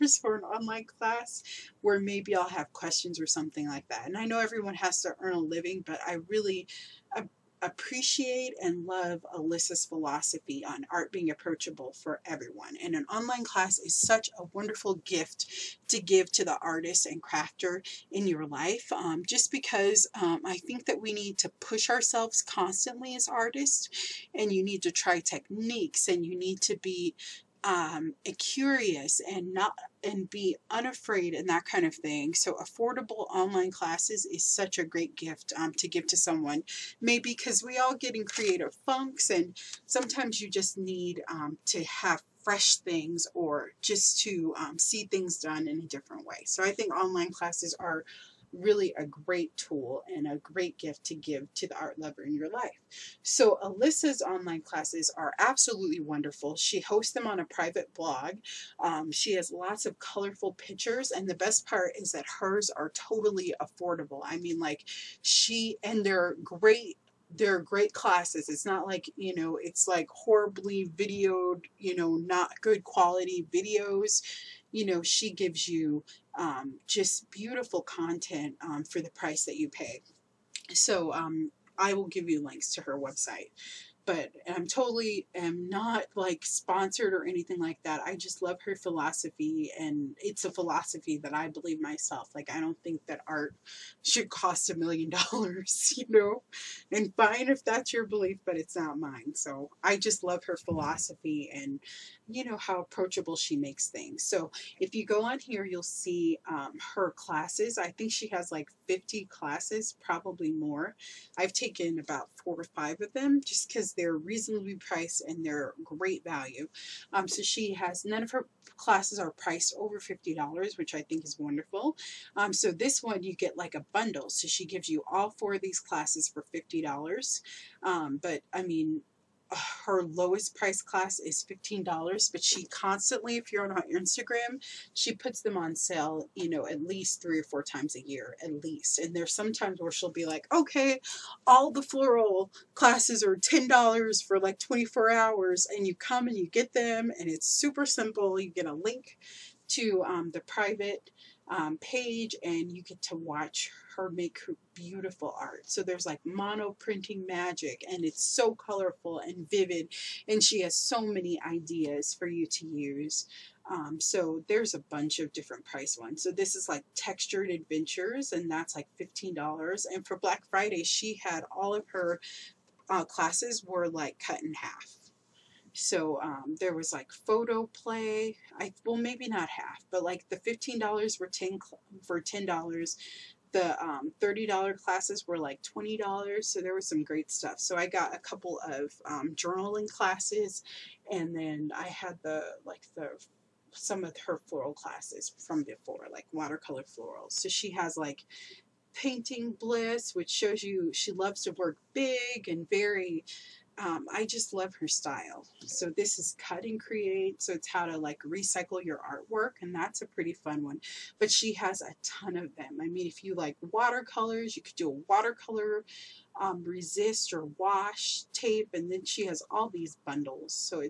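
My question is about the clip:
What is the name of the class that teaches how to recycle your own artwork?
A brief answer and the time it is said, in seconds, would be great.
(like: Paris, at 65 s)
Cut and Create, at 206 s.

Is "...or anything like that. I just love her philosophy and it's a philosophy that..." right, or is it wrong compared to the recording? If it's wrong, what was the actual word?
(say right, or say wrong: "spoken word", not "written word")
right.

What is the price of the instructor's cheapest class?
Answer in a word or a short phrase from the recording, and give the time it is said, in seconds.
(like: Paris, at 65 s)
$15, at 130 s.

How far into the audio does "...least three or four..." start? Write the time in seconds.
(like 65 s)
136 s.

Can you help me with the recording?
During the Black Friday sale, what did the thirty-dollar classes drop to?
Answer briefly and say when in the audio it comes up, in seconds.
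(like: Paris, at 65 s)
$20, at 185 s.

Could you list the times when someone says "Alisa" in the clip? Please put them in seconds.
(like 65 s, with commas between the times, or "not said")
9 s, 53 s.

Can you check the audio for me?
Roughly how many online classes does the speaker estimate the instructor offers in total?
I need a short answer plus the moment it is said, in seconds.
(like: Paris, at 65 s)
50, at 108 s.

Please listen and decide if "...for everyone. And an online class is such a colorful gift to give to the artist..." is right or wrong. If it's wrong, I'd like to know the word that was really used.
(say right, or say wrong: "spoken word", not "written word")
wrong: "wonderful", not "colorful".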